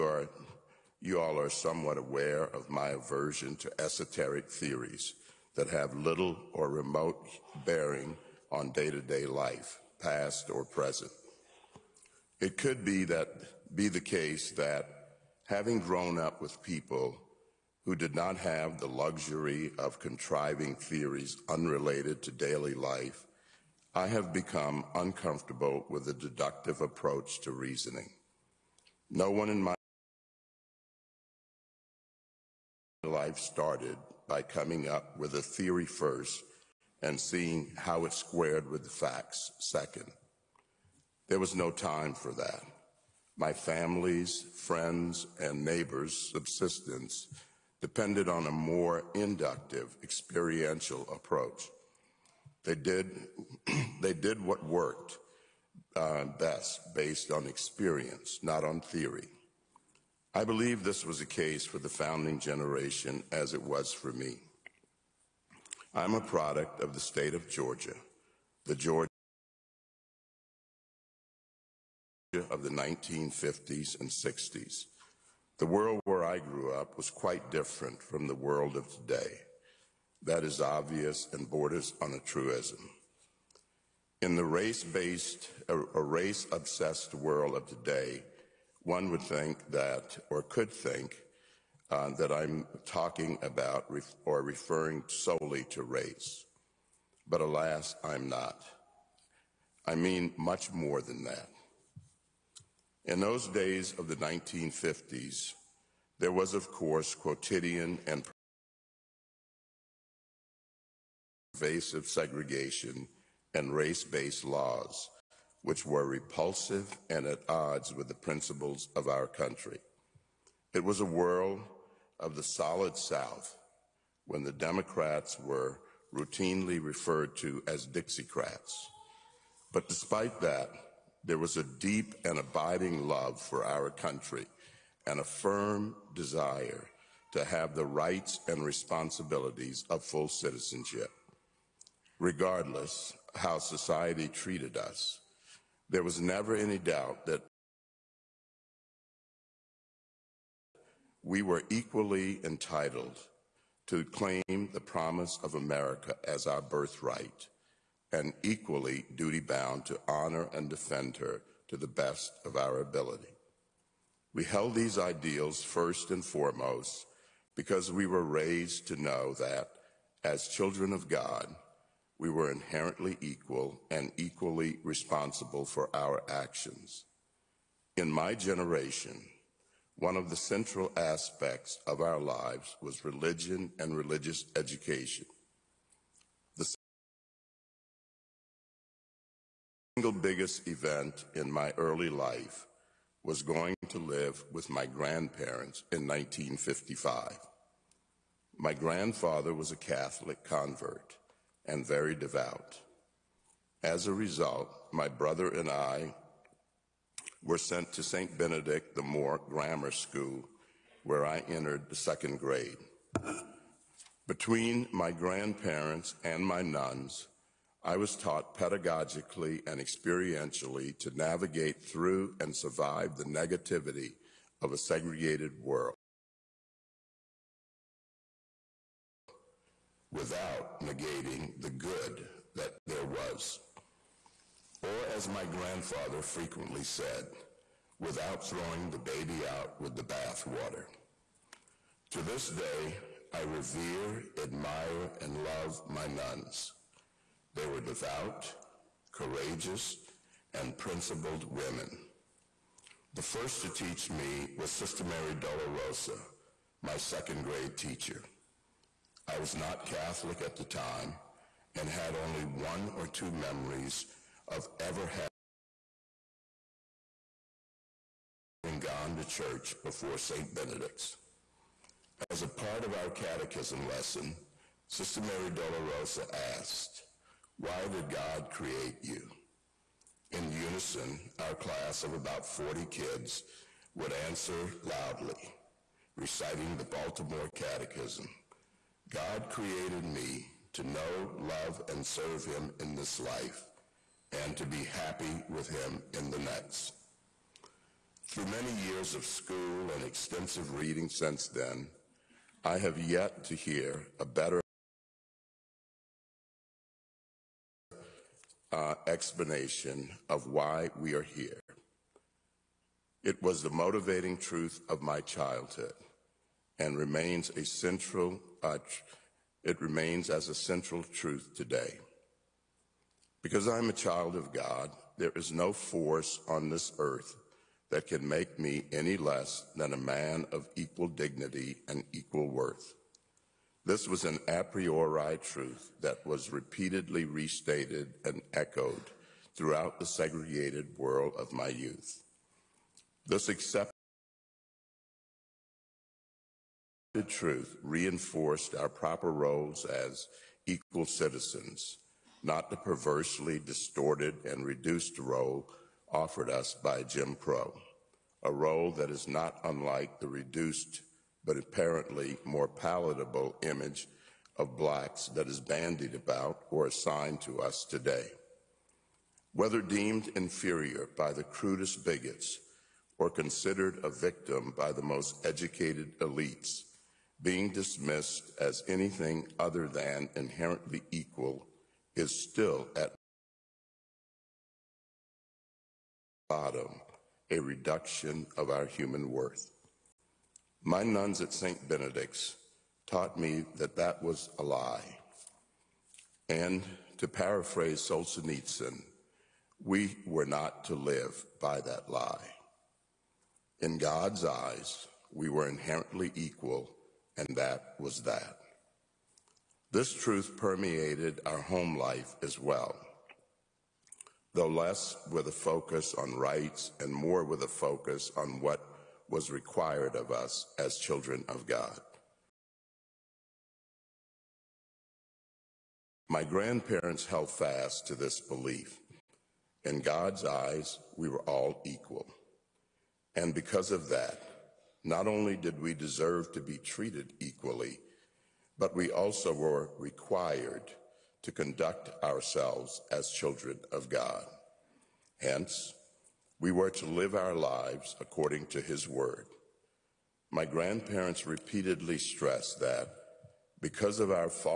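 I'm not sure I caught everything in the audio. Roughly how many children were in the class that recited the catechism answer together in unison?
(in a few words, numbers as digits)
40.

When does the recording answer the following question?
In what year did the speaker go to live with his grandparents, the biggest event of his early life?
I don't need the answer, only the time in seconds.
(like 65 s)
196 s.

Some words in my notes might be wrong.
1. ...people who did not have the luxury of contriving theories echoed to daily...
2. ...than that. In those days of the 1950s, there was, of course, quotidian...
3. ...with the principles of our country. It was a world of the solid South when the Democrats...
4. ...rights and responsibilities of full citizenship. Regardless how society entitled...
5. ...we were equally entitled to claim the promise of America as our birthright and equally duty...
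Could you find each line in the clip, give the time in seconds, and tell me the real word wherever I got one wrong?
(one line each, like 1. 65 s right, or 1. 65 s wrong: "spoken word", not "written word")
1. 16 s wrong: "unrelated", not "echoed"
2. 101 s right
3. 117 s right
4. 137 s wrong: "treated", not "entitled"
5. 151 s right.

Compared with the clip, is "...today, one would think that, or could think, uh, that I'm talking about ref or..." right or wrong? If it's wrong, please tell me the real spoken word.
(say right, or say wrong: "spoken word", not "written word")
right.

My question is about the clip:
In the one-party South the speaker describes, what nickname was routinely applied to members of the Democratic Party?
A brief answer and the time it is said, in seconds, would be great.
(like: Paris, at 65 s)
Dixiecrats, at 127 s.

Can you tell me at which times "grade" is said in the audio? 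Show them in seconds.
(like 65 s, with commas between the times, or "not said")
212 s, 257 s.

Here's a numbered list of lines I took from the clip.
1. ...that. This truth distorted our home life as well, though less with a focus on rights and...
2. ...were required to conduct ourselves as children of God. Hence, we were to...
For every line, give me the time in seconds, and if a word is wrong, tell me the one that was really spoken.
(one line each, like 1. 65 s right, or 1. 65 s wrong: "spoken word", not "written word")
1. 408 s wrong: "permeated", not "distorted"
2. 439 s right.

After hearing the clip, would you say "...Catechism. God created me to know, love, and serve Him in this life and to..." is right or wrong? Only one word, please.
right.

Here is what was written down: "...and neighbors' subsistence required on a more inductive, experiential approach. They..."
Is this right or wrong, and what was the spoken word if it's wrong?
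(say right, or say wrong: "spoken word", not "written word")
wrong: "depended", not "required".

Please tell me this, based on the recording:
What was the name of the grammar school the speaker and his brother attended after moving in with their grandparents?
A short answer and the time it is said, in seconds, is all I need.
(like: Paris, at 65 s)
St. Benedict the Moor Grammar School, at 208 s.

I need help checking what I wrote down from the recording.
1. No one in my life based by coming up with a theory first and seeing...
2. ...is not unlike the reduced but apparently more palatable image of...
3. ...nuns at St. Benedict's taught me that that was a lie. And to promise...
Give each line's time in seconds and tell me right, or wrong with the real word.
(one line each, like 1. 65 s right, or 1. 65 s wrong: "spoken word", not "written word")
1. 29 s wrong: "started", not "based"
2. 359 s right
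3. 391 s wrong: "paraphrase", not "promise".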